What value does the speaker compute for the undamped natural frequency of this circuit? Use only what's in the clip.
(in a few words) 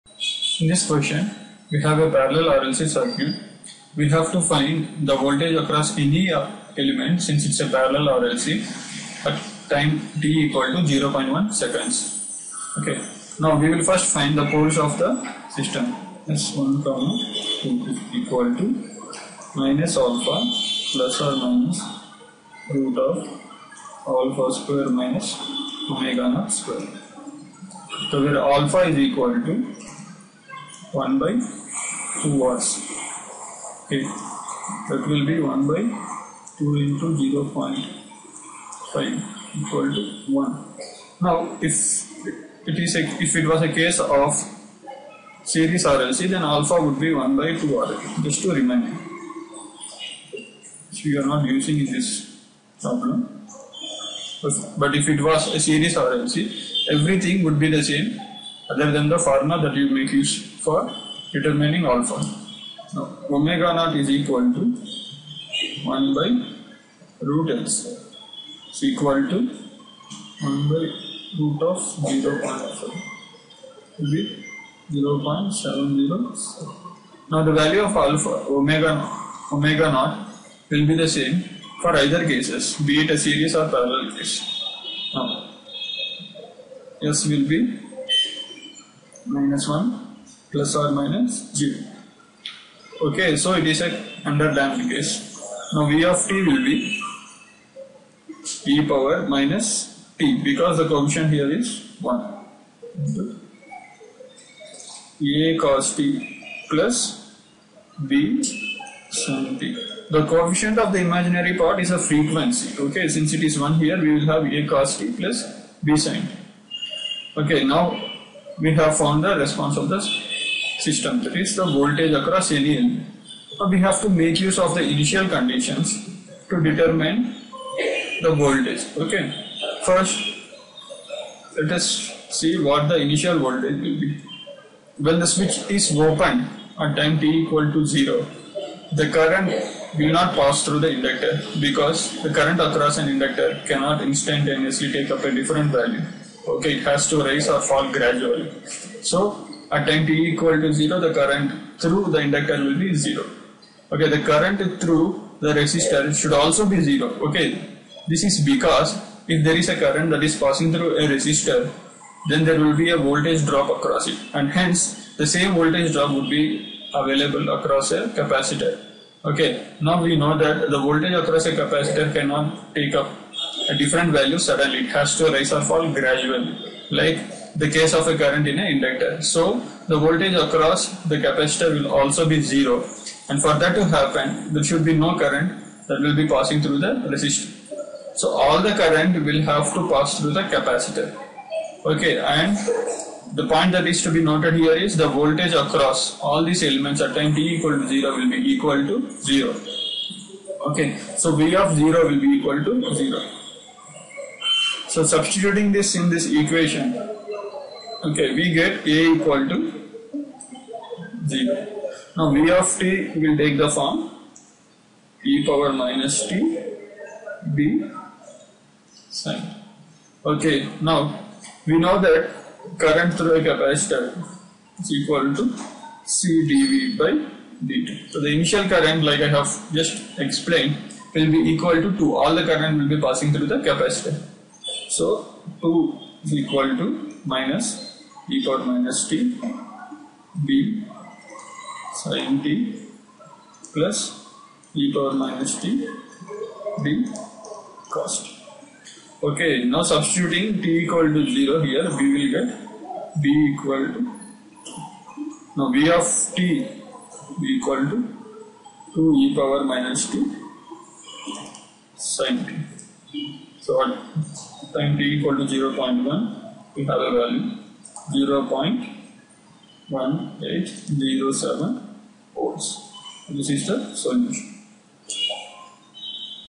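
0.707.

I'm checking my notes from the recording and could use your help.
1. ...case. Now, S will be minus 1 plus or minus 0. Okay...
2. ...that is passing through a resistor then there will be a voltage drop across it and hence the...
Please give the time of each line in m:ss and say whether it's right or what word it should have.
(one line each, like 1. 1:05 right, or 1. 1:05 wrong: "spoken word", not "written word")
1. 1:24 right
2. 2:40 right.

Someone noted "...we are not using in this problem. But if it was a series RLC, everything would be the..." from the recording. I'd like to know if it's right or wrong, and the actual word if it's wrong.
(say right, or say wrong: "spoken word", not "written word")
right.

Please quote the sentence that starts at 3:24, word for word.
So substituting this in this equation Okay, we get A equal to 0.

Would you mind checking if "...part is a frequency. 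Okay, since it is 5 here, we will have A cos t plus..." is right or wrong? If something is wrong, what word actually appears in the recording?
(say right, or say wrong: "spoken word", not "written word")
wrong: "1", not "5".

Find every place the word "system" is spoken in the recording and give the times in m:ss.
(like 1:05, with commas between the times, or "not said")
0:15, 2:00.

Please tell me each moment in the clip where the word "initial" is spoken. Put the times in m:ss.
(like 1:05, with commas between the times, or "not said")
2:04, 2:13, 3:48.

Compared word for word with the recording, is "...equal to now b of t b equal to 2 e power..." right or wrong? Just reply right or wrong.
right.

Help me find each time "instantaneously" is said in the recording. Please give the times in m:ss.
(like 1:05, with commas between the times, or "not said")
2:24.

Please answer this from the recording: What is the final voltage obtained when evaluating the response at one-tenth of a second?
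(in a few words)
0.1807 volts.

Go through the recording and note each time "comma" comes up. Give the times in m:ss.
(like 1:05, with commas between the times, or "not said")
0:16.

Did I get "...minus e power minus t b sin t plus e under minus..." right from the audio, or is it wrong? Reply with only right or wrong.
wrong.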